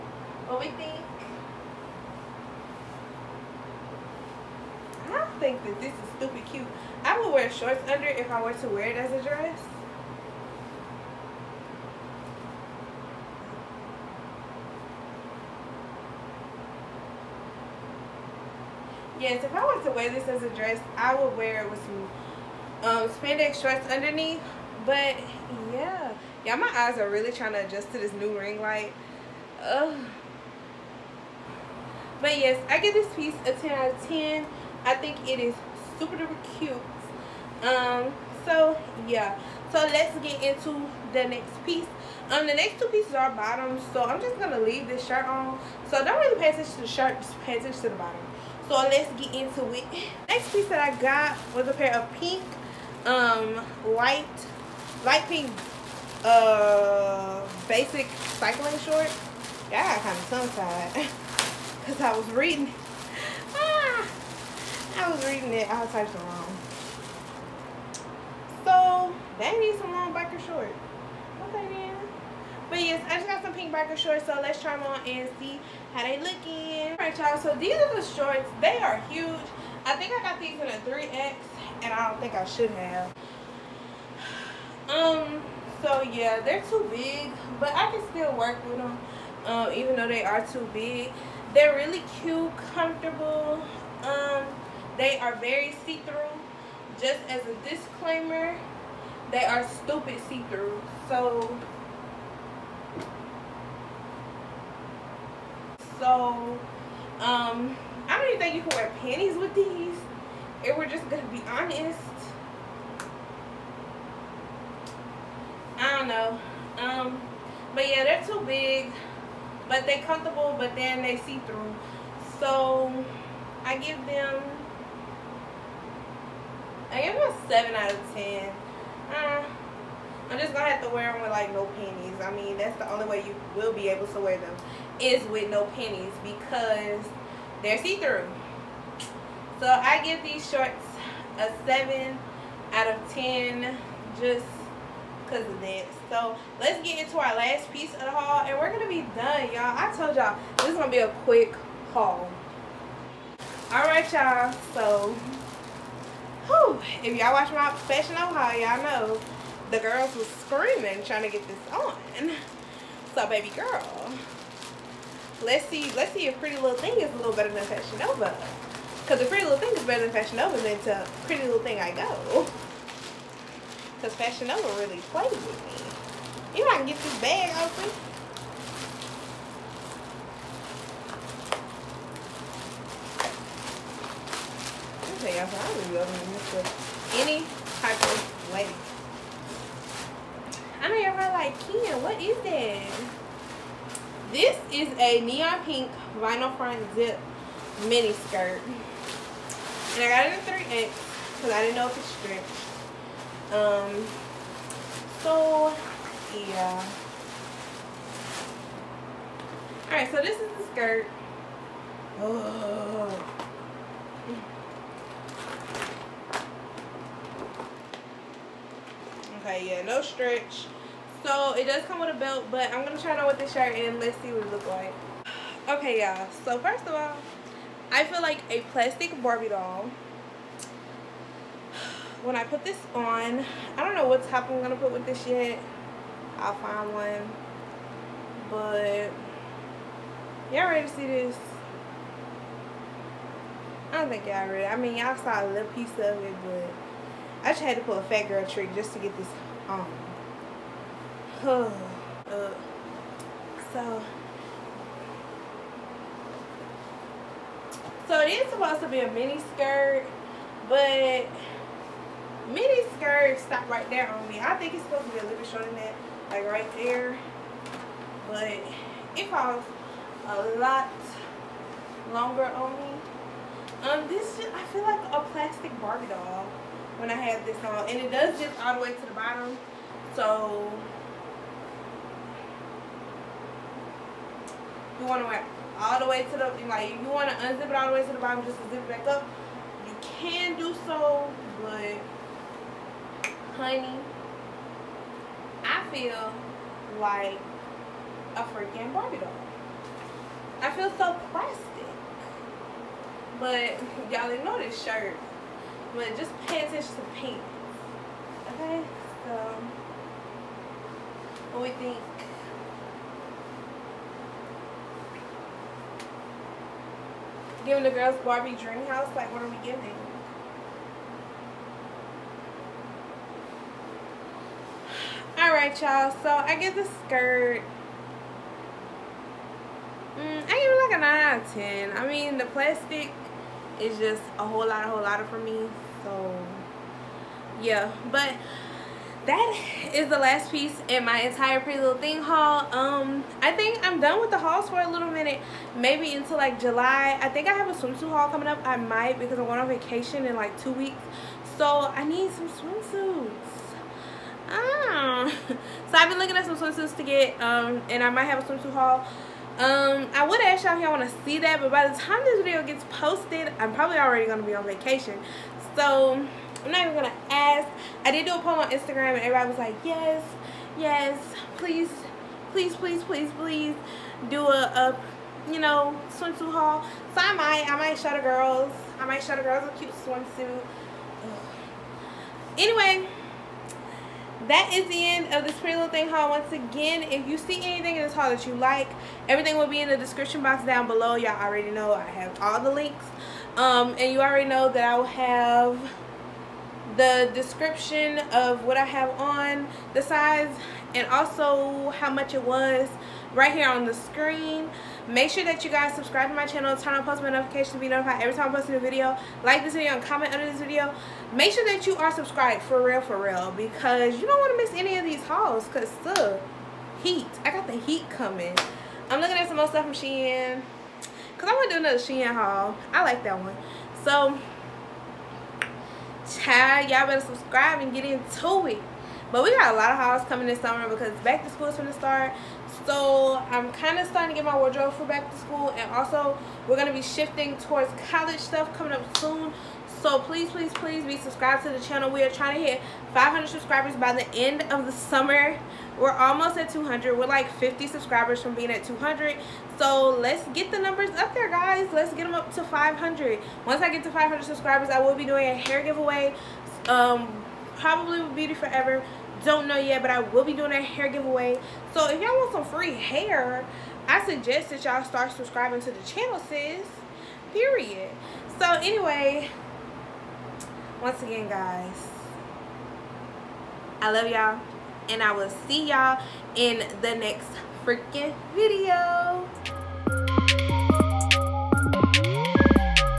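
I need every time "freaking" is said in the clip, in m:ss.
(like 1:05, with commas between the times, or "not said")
4:58, 7:57.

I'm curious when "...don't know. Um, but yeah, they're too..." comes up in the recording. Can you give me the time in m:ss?
1:55.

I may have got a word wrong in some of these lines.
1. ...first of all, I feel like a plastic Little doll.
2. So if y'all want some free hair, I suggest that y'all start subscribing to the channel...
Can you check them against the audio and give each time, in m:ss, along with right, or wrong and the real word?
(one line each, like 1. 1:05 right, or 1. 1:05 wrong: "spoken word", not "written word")
1. 3:46 wrong: "Barbie", not "Little"
2. 7:41 right.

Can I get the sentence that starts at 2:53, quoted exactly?
Because Fashion Nova really plays with me.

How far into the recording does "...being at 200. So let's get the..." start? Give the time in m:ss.
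7:28.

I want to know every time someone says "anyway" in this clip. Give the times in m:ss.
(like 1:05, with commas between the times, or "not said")
6:22, 7:48.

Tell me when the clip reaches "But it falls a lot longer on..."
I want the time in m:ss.
4:28.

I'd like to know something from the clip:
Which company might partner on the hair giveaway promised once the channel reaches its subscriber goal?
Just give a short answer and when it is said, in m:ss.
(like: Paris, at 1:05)
Beauty Forever, at 7:38.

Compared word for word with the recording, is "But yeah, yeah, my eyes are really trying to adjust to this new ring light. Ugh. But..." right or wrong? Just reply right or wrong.
right.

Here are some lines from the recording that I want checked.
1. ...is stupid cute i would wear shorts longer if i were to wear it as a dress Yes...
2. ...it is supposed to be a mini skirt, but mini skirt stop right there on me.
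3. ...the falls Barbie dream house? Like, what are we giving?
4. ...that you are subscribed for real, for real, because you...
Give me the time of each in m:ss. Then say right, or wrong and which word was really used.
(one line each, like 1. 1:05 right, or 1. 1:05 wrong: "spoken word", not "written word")
1. 0:05 wrong: "under", not "longer"
2. 4:18 right
3. 5:17 wrong: "girls", not "falls"
4. 6:51 right.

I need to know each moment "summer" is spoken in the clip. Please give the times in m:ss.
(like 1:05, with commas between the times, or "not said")
7:10, 7:24.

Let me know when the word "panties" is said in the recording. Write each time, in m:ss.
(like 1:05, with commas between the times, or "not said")
1:49, 2:11.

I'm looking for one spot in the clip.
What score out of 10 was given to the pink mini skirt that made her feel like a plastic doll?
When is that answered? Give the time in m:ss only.
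5:31.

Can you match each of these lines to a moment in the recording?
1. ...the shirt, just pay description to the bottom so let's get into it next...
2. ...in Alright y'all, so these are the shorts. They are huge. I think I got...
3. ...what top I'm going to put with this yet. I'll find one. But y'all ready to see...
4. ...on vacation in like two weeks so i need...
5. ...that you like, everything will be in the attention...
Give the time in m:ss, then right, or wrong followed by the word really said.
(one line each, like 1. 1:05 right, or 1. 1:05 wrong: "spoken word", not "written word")
1. 0:46 wrong: "attention", not "description"
2. 1:16 right
3. 3:54 right
4. 5:49 right
5. 6:28 wrong: "description", not "attention".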